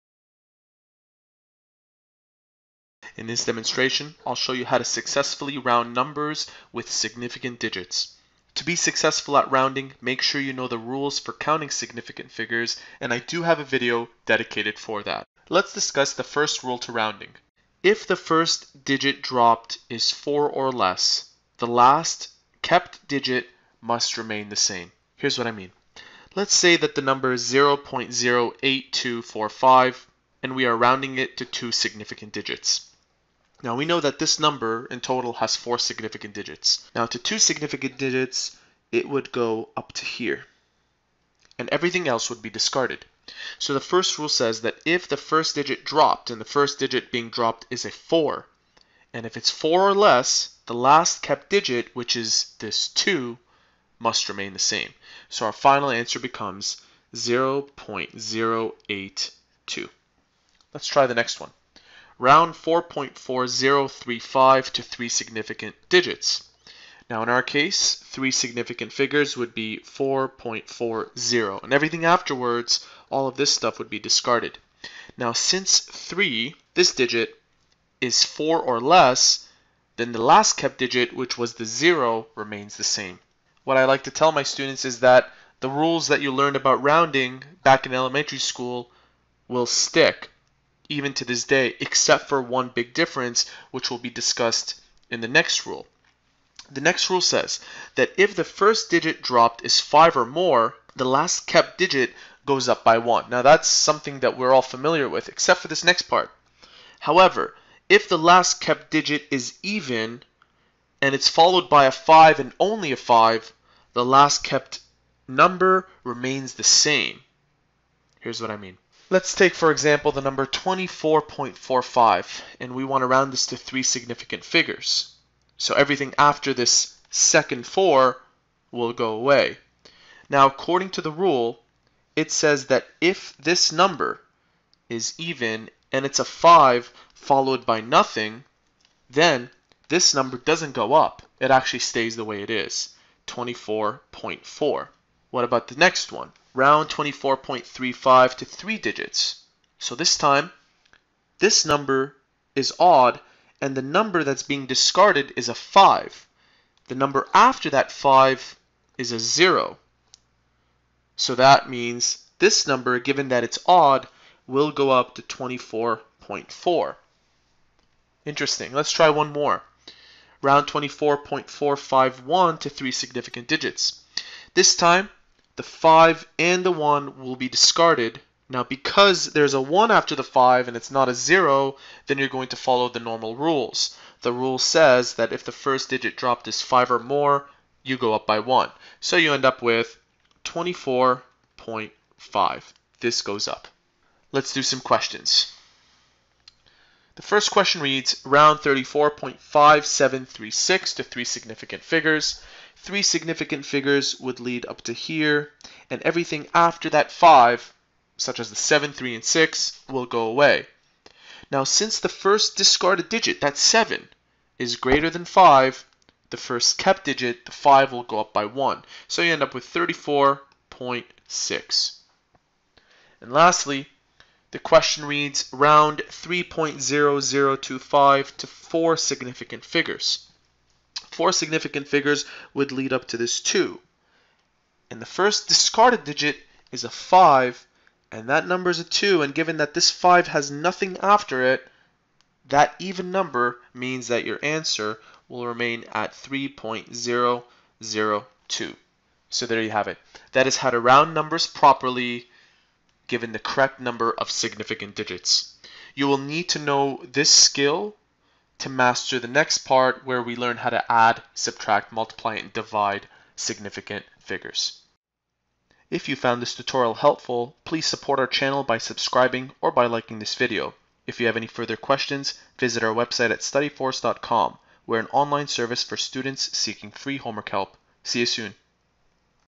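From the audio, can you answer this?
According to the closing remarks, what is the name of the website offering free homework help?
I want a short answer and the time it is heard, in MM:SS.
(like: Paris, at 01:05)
studyforce.com, at 04:33.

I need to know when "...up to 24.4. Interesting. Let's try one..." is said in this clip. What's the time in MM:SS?
02:44.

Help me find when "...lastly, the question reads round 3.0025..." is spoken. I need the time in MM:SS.
03:43.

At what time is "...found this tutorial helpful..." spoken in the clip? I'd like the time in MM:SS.
04:26.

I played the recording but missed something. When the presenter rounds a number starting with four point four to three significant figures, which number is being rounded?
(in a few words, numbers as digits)
4.4035.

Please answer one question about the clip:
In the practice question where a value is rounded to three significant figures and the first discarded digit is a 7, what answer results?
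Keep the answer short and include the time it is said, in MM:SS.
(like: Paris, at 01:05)
34.6, at 03:39.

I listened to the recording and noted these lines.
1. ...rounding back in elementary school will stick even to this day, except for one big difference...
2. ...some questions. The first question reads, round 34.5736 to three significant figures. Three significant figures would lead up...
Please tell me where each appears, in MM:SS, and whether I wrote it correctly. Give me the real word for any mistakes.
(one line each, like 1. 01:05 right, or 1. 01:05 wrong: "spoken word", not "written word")
1. 01:26 right
2. 03:14 right.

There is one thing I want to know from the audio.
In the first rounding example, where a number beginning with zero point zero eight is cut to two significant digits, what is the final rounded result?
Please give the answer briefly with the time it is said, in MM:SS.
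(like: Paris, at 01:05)
0.082, at 00:57.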